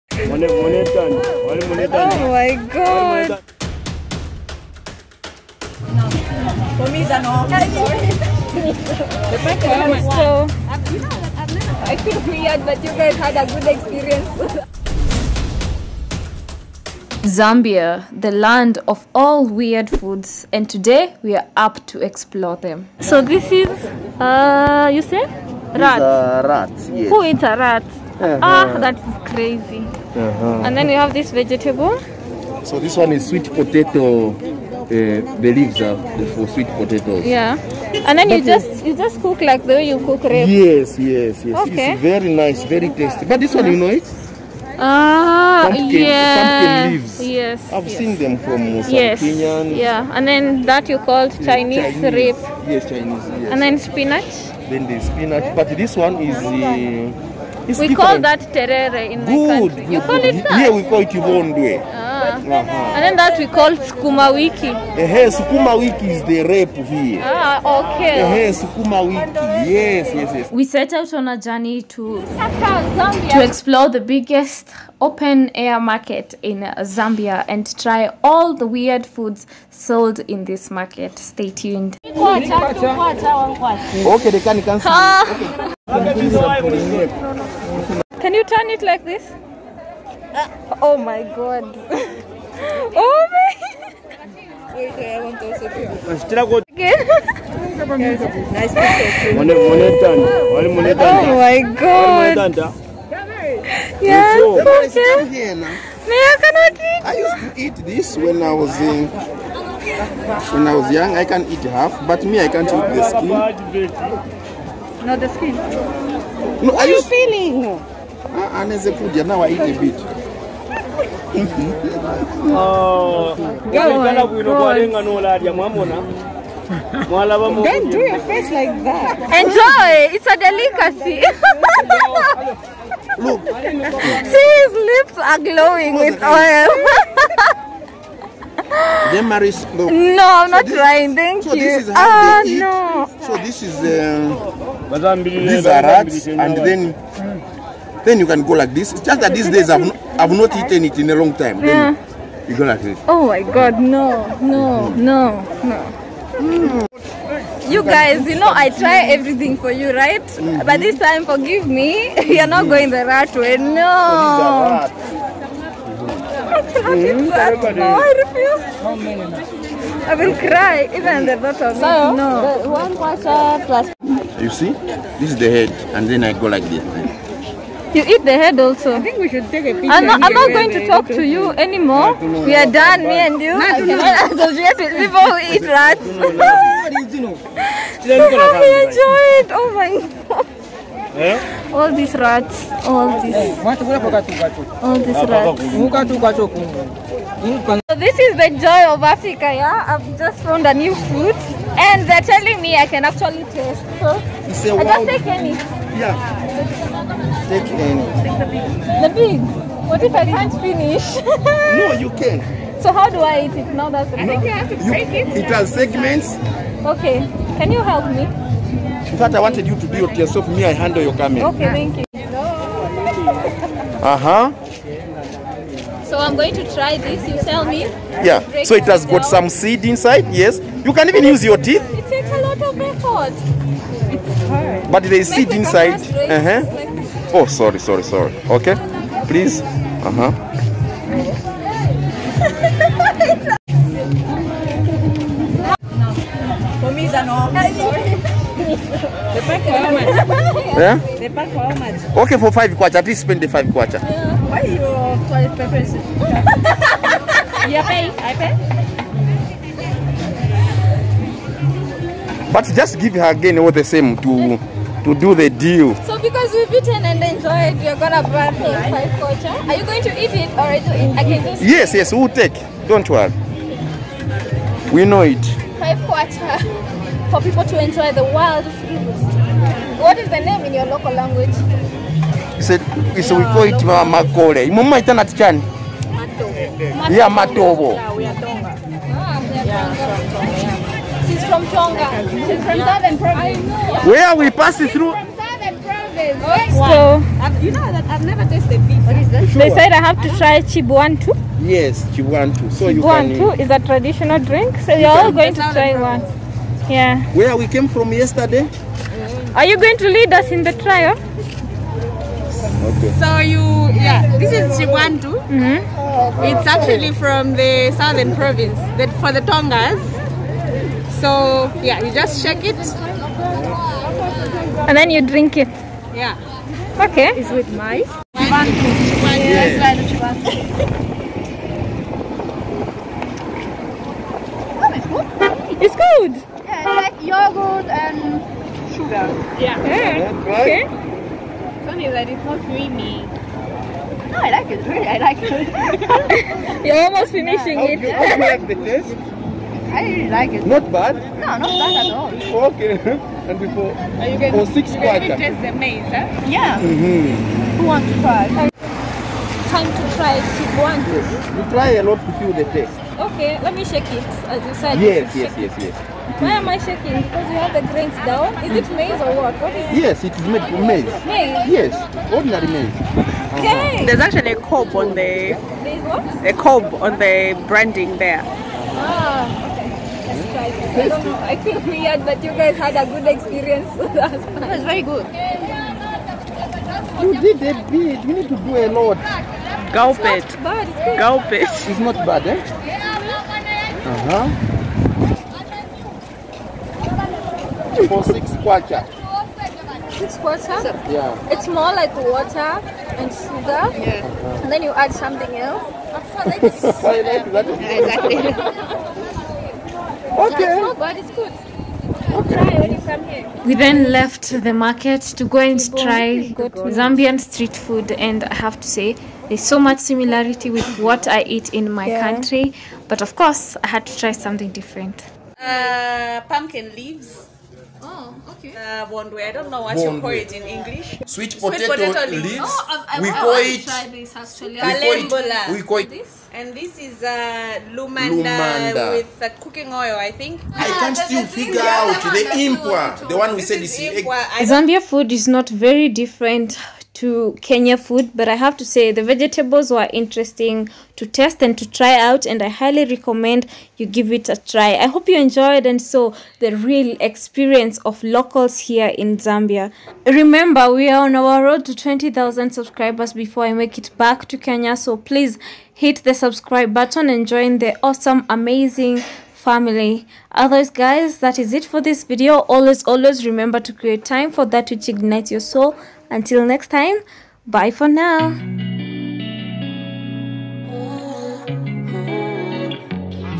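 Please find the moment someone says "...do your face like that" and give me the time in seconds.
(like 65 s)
127 s.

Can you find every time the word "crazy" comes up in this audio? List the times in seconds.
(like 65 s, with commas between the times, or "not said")
29 s.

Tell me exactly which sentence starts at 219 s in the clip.
In fact, I wanted you to do it yourself.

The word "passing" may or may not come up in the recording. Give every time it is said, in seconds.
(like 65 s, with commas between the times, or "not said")
294 s.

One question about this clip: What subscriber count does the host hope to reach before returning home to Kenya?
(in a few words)
20,000.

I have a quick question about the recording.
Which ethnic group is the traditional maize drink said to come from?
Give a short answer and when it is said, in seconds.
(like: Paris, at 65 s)
Tonga, at 319 s.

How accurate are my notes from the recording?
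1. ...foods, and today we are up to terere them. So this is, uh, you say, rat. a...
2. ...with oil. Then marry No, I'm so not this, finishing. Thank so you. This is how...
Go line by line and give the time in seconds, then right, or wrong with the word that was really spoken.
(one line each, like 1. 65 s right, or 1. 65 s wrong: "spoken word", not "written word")
1. 19 s wrong: "explore", not "terere"
2. 135 s wrong: "trying", not "finishing".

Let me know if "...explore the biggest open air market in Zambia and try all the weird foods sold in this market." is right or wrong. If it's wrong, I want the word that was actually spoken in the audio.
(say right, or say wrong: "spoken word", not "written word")
right.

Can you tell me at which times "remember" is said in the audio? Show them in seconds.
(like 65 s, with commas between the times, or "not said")
460 s, 473 s.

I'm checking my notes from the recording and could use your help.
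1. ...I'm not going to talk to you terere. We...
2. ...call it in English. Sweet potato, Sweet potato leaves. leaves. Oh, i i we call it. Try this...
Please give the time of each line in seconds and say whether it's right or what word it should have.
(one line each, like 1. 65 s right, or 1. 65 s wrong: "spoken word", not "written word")
1. 180 s wrong: "anymore", not "terere"
2. 430 s right.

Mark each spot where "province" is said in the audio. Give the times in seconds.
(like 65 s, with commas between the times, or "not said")
293 s, 318 s.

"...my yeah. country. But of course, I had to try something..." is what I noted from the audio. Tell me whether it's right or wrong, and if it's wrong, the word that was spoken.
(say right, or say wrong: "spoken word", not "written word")
right.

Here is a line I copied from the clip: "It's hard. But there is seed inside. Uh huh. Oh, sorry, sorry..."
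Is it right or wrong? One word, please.
right.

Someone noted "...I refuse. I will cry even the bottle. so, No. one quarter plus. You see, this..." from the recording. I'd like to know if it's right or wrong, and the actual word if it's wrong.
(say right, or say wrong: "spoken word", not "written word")
right.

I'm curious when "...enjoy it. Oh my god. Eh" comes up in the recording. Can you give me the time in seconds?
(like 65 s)
188 s.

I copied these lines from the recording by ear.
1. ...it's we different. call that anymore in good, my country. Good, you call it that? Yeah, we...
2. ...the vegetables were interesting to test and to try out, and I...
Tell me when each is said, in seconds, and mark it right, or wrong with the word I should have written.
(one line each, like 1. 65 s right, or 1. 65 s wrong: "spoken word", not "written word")
1. 57 s wrong: "terere", not "anymore"
2. 449 s right.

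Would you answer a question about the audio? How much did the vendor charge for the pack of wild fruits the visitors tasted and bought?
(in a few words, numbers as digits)
5 kwacha.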